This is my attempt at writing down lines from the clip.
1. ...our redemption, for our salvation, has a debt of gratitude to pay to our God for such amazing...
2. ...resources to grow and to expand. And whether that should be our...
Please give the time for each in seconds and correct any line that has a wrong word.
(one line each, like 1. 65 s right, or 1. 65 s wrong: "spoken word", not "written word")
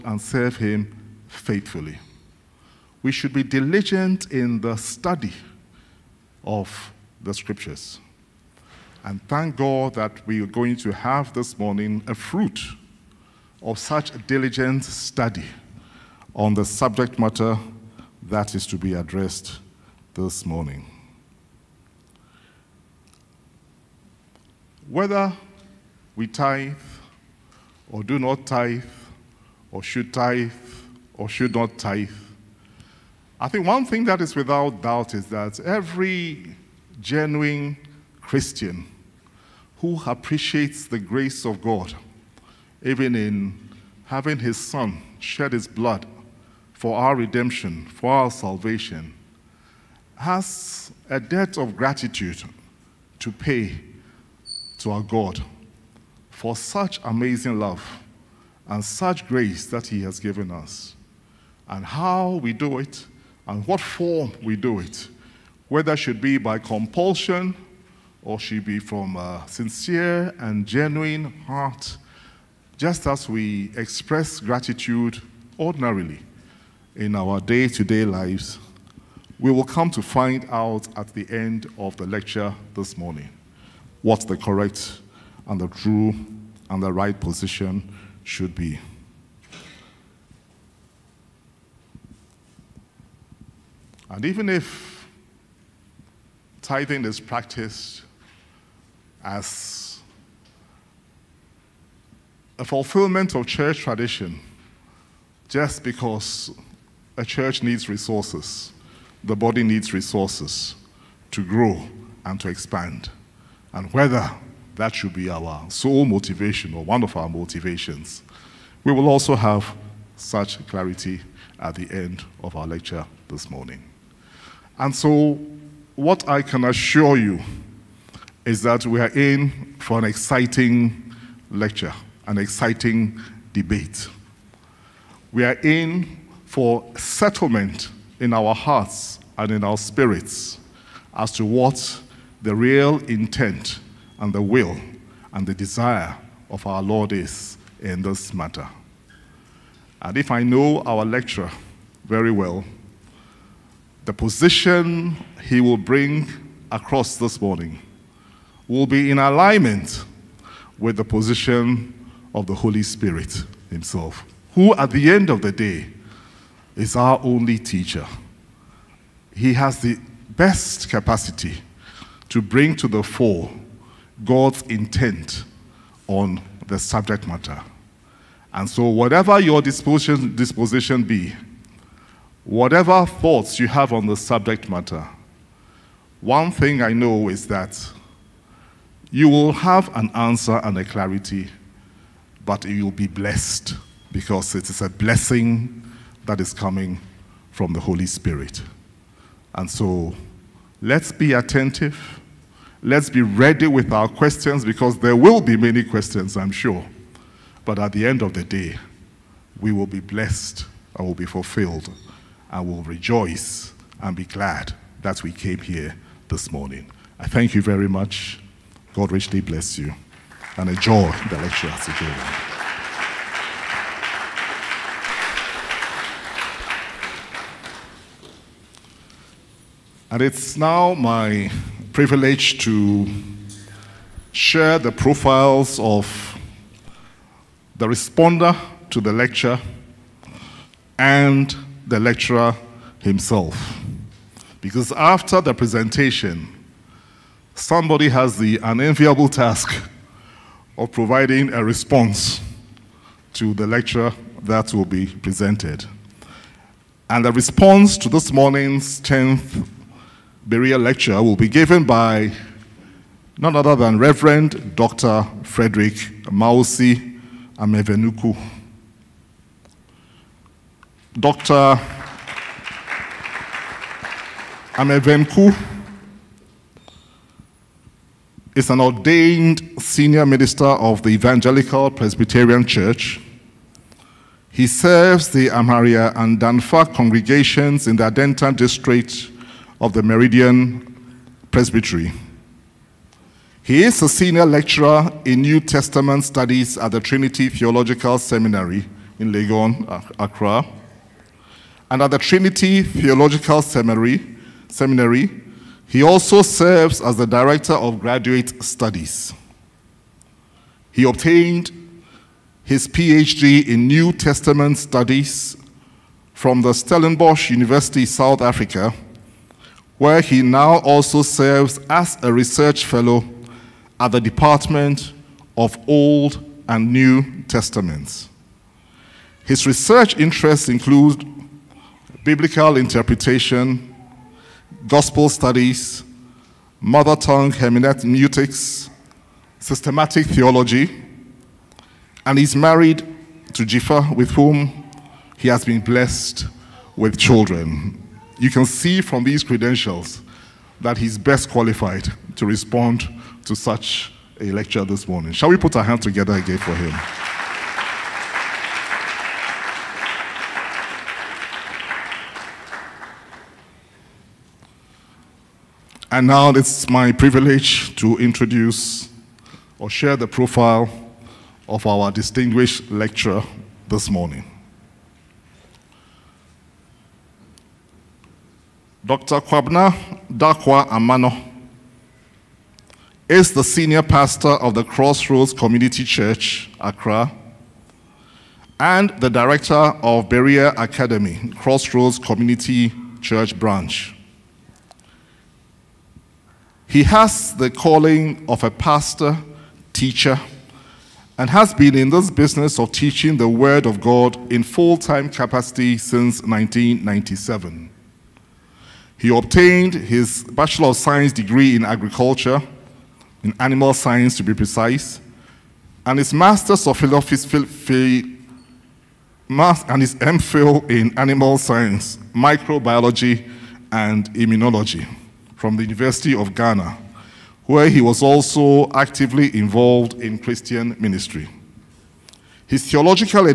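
1. 46 s right
2. 109 s right.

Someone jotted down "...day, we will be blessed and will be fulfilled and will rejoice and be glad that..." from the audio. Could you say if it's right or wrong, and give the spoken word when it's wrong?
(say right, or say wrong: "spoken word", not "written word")
right.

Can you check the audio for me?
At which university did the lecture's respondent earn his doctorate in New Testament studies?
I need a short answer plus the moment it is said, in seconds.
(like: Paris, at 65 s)
Stellenbosch University, at 316 s.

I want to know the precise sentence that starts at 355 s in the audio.
Shall we put our hands together again for him?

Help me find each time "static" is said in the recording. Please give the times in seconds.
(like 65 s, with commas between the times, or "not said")
not said.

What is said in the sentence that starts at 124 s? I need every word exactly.
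And so, what I can assure you is that we are in for an exciting lecture, an exciting debate.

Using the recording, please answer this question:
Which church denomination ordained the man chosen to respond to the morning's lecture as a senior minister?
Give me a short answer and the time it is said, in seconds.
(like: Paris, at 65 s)
Evangelical Presbyterian Church, at 281 s.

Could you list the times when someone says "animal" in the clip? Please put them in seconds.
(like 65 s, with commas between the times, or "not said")
413 s, 421 s.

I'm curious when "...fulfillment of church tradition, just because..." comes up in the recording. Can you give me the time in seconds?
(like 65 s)
102 s.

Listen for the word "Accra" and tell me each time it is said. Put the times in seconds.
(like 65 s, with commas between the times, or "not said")
300 s, 386 s.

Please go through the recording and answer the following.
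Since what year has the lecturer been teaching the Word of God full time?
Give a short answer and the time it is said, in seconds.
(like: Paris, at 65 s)
1997, at 406 s.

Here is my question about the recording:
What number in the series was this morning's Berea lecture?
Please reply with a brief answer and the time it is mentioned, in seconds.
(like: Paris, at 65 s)
10th, at 259 s.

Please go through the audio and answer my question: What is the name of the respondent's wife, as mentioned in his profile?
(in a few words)
Jifa.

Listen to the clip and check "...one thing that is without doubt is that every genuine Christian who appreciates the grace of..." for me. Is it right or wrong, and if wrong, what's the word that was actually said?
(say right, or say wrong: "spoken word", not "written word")
right.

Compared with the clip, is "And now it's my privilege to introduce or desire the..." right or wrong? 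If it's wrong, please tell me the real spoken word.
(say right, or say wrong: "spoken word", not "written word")
wrong: "share", not "desire".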